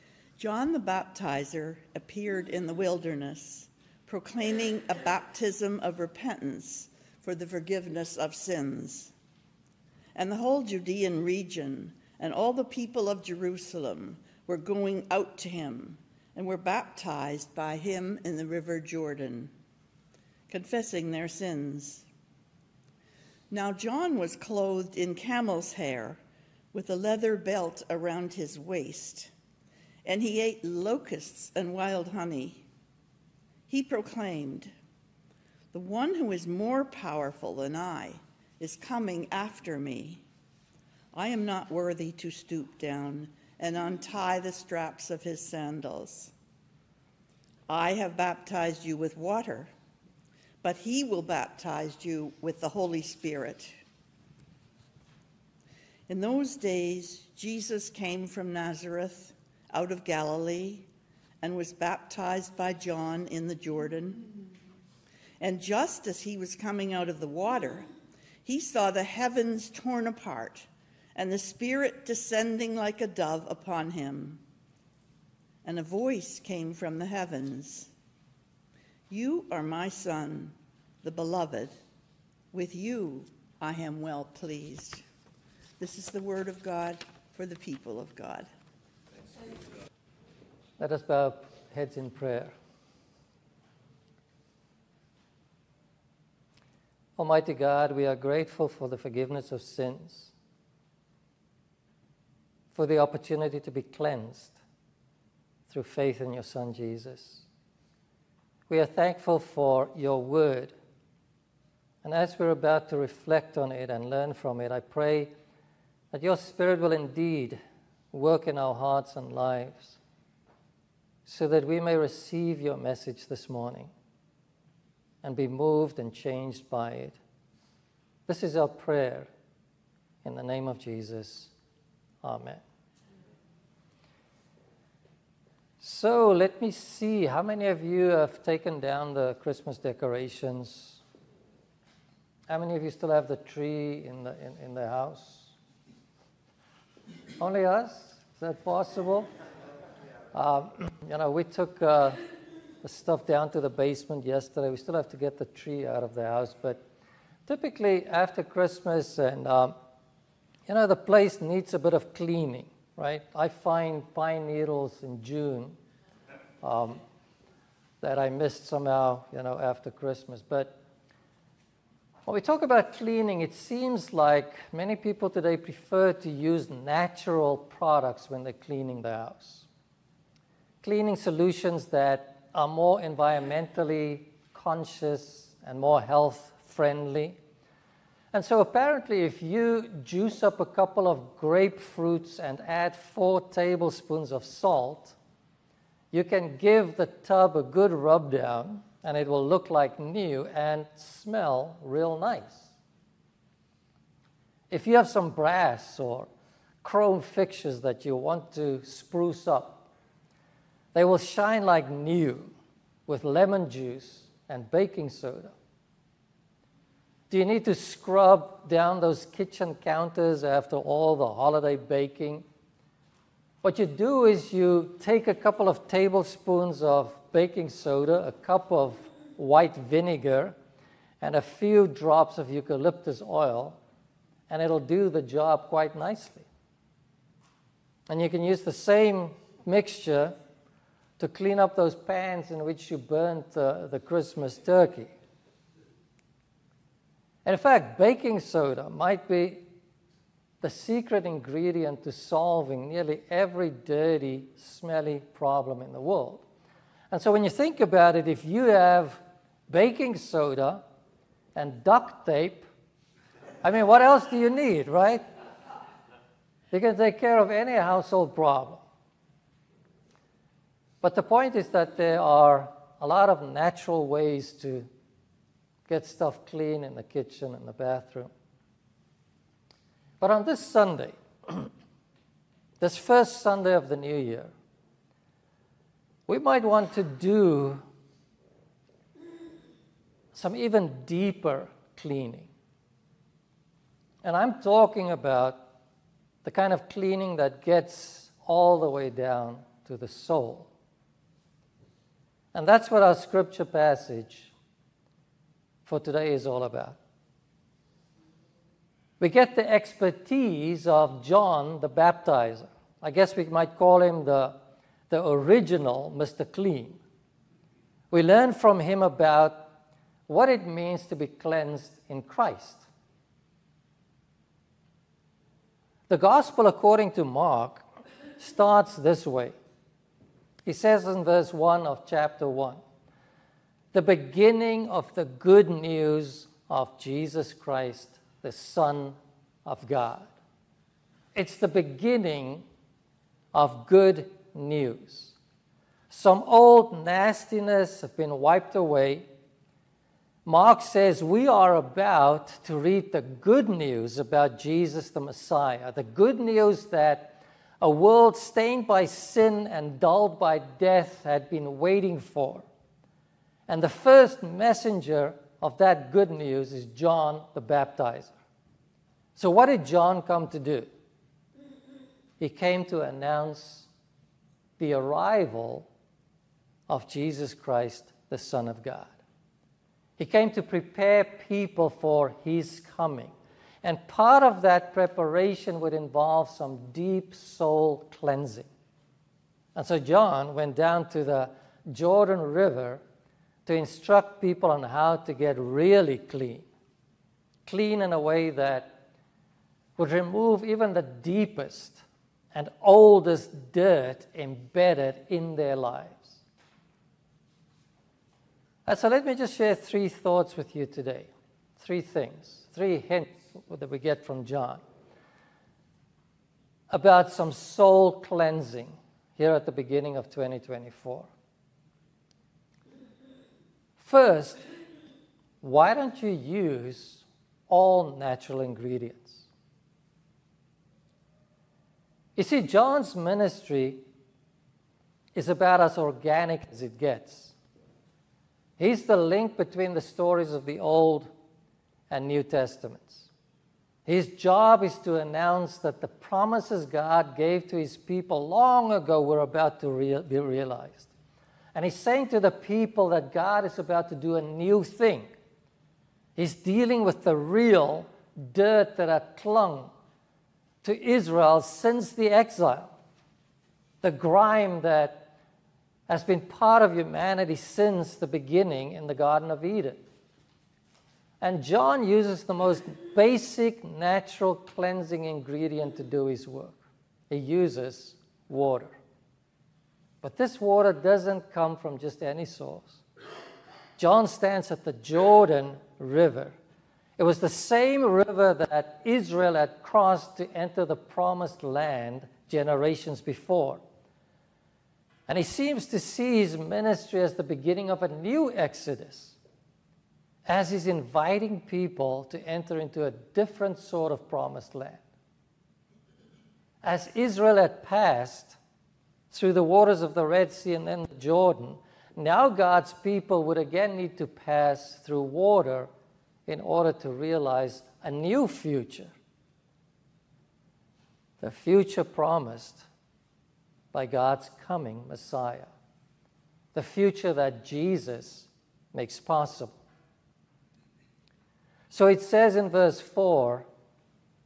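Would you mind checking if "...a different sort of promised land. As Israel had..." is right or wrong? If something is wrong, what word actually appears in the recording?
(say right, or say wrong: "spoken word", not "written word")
right.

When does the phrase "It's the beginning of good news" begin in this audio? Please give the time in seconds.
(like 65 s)
341 s.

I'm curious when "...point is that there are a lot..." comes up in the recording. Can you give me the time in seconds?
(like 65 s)
271 s.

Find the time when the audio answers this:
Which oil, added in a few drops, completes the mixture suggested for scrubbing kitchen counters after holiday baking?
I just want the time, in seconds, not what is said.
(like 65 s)
232 s.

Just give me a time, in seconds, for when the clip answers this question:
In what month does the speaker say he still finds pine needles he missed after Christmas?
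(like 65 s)
165 s.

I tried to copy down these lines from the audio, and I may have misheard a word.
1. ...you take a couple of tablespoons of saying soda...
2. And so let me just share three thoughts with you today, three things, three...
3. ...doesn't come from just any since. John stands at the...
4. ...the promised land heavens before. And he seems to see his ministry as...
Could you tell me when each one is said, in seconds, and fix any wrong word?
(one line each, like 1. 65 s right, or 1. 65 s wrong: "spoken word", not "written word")
1. 224 s wrong: "baking", not "saying"
2. 408 s right
3. 480 s wrong: "source", not "since"
4. 490 s wrong: "generations", not "heavens".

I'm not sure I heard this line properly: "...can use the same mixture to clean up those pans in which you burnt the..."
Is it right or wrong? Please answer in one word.
right.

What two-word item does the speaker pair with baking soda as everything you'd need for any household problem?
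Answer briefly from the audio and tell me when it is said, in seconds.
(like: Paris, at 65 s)
duct tape, at 261 s.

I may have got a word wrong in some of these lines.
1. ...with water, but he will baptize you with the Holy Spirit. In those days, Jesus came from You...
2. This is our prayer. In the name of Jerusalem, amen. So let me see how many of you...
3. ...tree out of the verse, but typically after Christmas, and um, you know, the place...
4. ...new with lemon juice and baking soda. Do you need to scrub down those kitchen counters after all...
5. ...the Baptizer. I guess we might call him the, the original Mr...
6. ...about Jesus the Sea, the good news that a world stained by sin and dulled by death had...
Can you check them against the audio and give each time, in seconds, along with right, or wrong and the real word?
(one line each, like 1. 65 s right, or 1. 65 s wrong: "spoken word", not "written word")
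1. 48 s wrong: "Nazareth", not "You"
2. 128 s wrong: "Jesus", not "Jerusalem"
3. 155 s wrong: "house", not "verse"
4. 211 s right
5. 311 s right
6. 354 s wrong: "Messiah", not "Sea".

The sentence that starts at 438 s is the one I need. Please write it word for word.
He's the link between the stories of the Old and New Testaments.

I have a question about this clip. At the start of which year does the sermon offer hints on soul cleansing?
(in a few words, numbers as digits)
2024.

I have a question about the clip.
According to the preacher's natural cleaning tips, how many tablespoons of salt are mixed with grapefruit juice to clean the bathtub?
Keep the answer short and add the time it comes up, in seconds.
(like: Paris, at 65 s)
4, at 192 s.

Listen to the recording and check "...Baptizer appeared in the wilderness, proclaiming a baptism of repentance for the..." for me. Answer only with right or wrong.
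right.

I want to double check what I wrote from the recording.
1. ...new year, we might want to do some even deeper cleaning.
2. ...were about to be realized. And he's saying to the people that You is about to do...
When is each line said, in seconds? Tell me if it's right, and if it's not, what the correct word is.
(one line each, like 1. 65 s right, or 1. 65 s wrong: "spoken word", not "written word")
1. 283 s right
2. 449 s wrong: "God", not "You".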